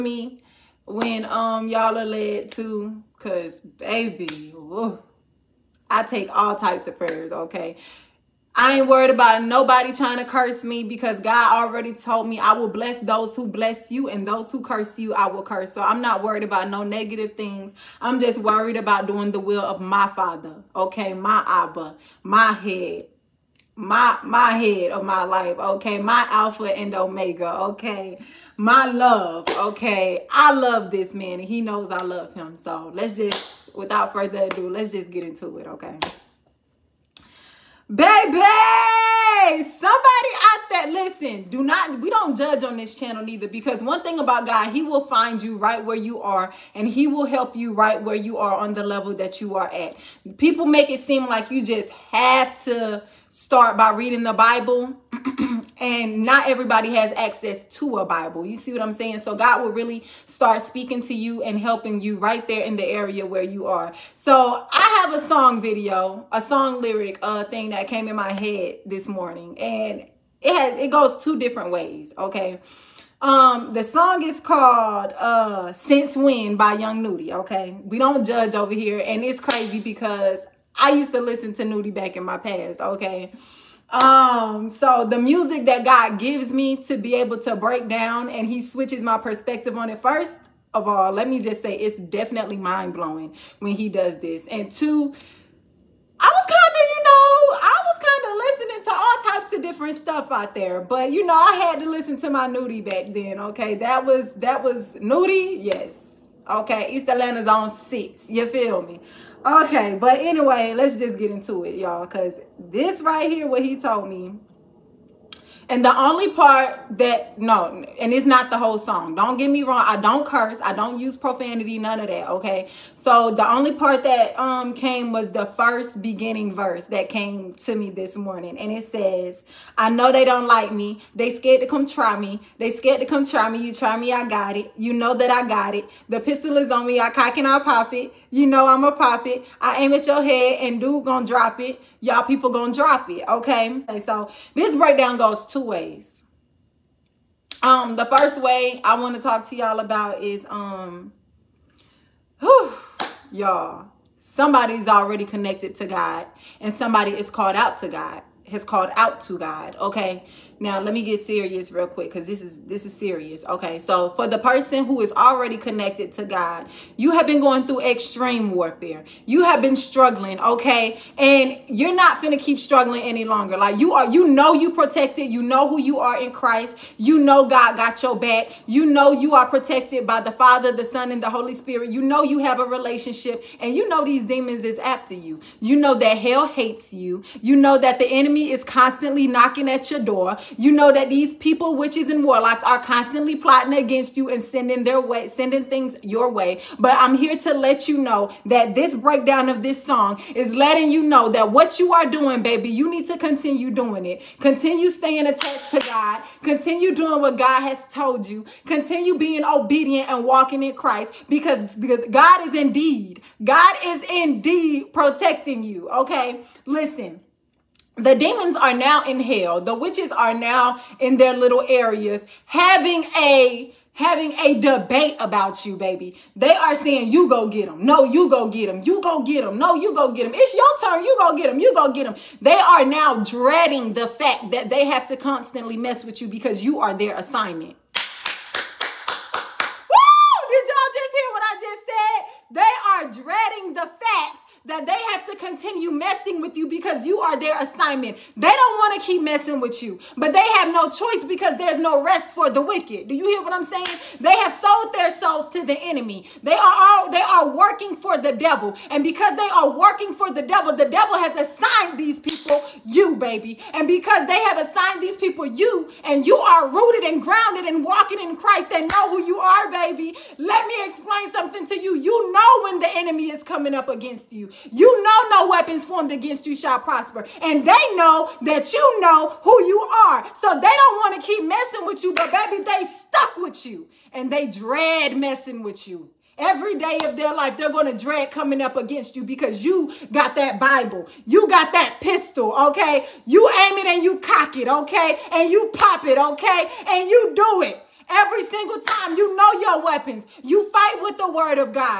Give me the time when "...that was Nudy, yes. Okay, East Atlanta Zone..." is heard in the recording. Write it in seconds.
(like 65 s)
104 s.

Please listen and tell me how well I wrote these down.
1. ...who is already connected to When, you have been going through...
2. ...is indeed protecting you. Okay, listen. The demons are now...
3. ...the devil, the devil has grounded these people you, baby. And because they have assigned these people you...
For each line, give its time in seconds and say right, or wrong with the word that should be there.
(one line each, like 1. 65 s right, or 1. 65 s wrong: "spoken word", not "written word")
1. 164 s wrong: "God", not "When"
2. 213 s right
3. 260 s wrong: "assigned", not "grounded".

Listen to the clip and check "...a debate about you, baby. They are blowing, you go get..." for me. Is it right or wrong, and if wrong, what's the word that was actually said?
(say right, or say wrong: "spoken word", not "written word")
wrong: "saying", not "blowing".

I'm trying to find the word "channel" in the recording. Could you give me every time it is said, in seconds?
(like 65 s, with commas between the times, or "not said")
42 s.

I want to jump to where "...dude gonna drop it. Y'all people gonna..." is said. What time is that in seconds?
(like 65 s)
140 s.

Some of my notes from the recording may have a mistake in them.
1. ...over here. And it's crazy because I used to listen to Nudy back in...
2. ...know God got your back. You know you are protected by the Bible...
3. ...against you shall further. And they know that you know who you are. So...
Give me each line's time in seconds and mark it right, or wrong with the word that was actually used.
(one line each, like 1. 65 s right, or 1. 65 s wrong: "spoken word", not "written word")
1. 78 s right
2. 177 s wrong: "Father", not "Bible"
3. 276 s wrong: "prosper", not "further".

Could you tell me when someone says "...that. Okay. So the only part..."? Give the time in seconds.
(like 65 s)
122 s.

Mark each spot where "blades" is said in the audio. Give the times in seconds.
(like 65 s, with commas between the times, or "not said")
not said.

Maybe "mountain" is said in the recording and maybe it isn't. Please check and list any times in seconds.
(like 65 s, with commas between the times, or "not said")
not said.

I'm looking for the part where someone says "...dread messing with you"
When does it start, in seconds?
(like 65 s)
284 s.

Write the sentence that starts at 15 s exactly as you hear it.
So I'm not worried about no negative things.